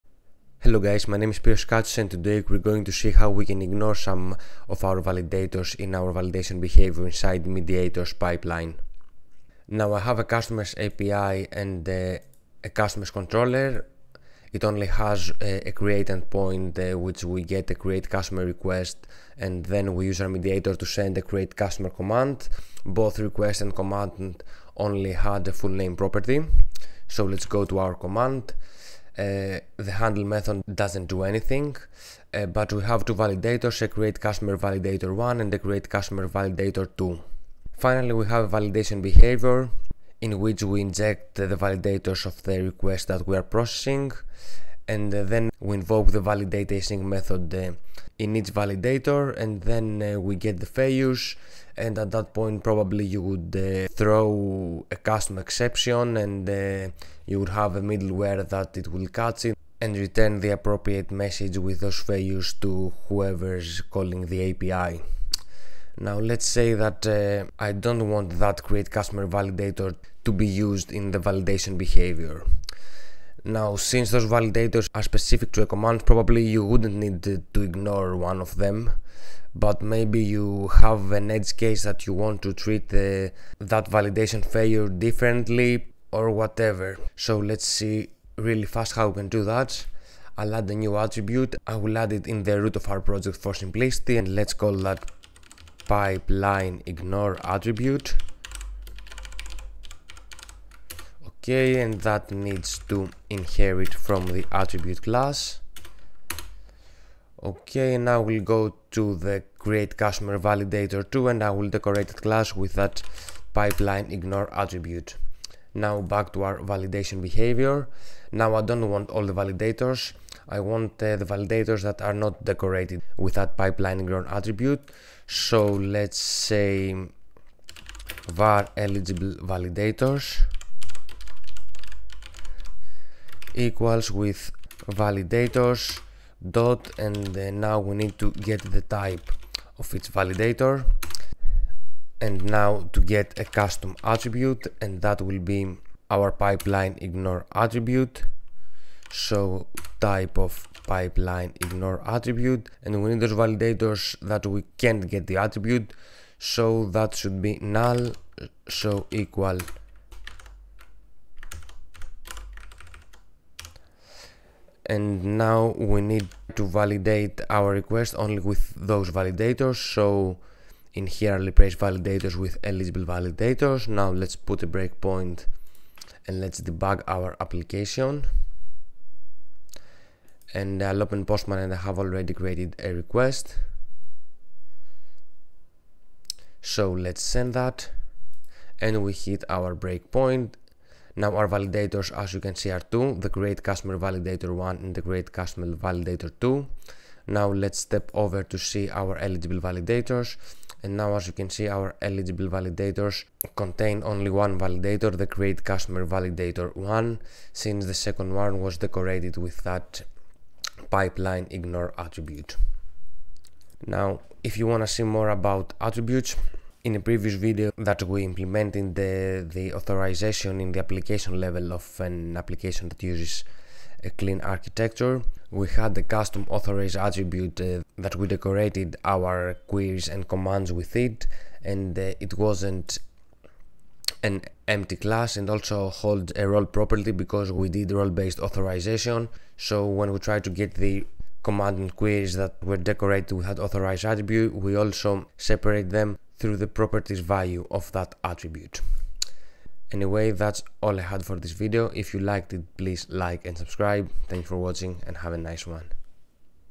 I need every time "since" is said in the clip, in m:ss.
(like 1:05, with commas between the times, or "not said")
1:13, 3:27.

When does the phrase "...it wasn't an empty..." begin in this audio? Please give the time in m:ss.
3:52.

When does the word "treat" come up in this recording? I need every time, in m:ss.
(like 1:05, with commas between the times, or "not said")
1:22.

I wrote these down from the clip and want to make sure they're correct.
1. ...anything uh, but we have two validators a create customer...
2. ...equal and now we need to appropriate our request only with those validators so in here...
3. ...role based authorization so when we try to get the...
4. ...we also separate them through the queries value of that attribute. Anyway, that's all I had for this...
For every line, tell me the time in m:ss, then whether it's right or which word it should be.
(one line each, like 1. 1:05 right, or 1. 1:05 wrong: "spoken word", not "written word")
1. 0:31 right
2. 2:39 wrong: "validate", not "appropriate"
3. 3:57 right
4. 4:04 wrong: "properties", not "queries".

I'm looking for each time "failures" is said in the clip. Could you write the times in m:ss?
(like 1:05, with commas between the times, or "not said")
0:50, 1:02, 1:24.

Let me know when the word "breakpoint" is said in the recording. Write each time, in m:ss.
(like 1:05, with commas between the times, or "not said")
2:54, 3:09.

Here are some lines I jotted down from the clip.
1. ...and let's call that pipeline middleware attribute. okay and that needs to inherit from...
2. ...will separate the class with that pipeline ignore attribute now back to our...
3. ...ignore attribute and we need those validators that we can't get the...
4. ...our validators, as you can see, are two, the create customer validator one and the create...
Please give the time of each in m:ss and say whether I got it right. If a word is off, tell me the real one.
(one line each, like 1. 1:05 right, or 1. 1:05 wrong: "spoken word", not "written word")
1. 1:34 wrong: "ignore", not "middleware"
2. 1:51 wrong: "decorate", not "separate"
3. 2:31 right
4. 3:11 right.